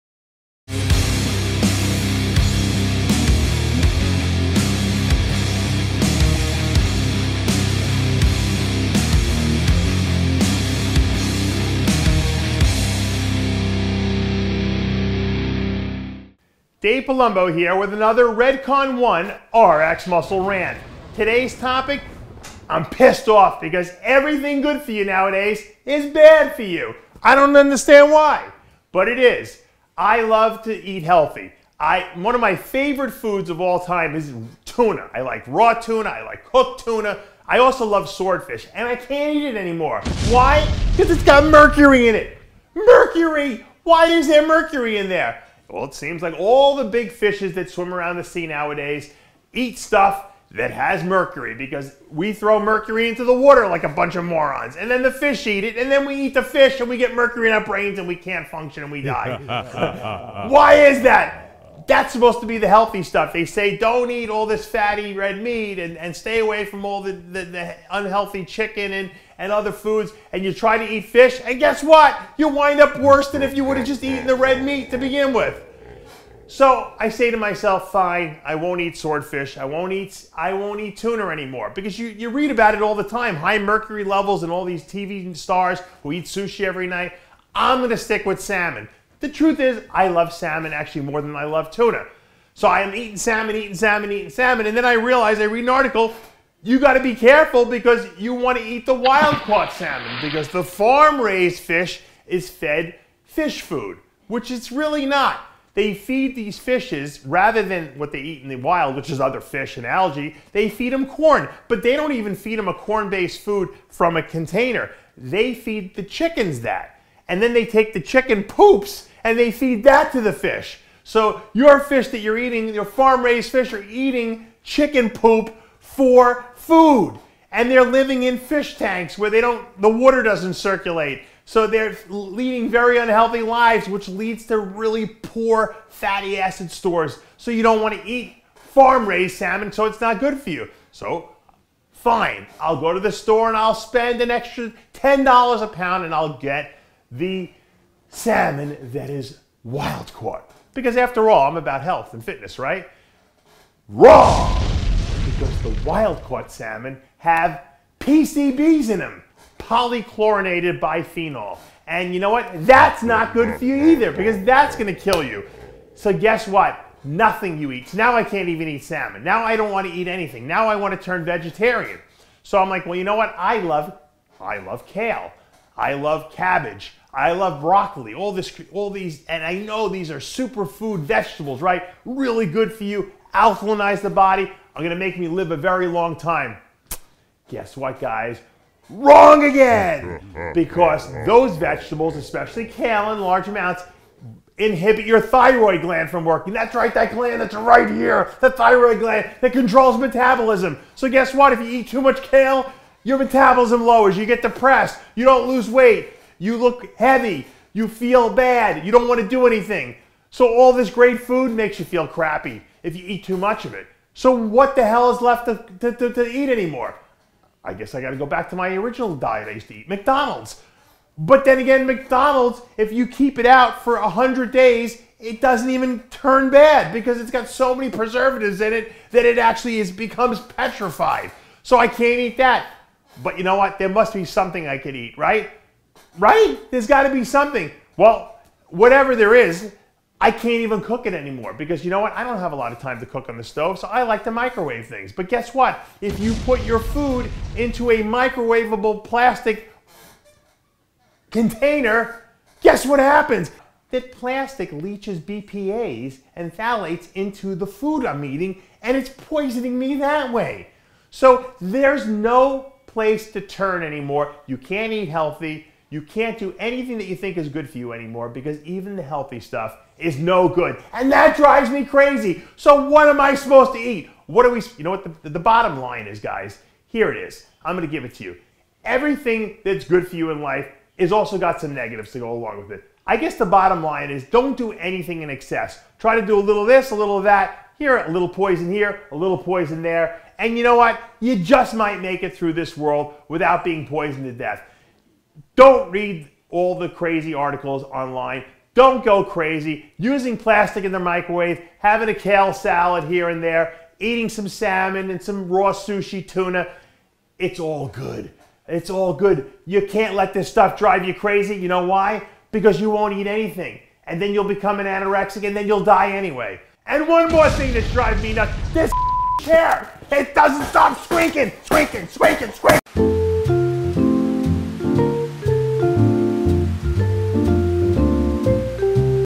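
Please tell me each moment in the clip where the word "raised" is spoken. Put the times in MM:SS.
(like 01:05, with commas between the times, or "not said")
01:41, 02:02, 02:18.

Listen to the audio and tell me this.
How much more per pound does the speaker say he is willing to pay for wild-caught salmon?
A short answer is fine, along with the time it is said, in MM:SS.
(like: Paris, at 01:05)
$10, at 02:24.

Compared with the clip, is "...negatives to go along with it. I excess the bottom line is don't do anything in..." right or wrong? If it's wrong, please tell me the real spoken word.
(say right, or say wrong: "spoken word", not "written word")
wrong: "guess", not "excess".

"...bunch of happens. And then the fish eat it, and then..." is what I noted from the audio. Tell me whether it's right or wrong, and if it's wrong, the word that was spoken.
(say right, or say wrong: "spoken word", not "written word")
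wrong: "morons", not "happens".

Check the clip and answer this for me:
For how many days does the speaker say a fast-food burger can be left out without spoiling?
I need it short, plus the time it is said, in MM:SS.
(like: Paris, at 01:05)
100, at 03:44.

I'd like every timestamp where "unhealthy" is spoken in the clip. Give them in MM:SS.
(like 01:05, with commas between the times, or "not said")
01:07, 02:12.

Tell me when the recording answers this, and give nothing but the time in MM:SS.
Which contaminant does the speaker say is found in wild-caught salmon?
02:39.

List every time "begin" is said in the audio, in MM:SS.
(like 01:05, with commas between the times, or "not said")
01:14.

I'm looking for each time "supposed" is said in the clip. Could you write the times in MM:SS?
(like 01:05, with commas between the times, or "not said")
01:02, 04:33.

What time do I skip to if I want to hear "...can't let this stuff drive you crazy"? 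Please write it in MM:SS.
05:09.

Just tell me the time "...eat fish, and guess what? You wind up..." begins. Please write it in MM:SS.
01:10.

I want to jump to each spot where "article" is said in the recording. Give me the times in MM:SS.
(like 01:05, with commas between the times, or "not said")
01:35, 04:57.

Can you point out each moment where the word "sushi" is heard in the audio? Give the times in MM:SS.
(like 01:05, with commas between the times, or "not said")
01:26, 05:05.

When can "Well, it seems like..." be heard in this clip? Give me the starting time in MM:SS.
00:45.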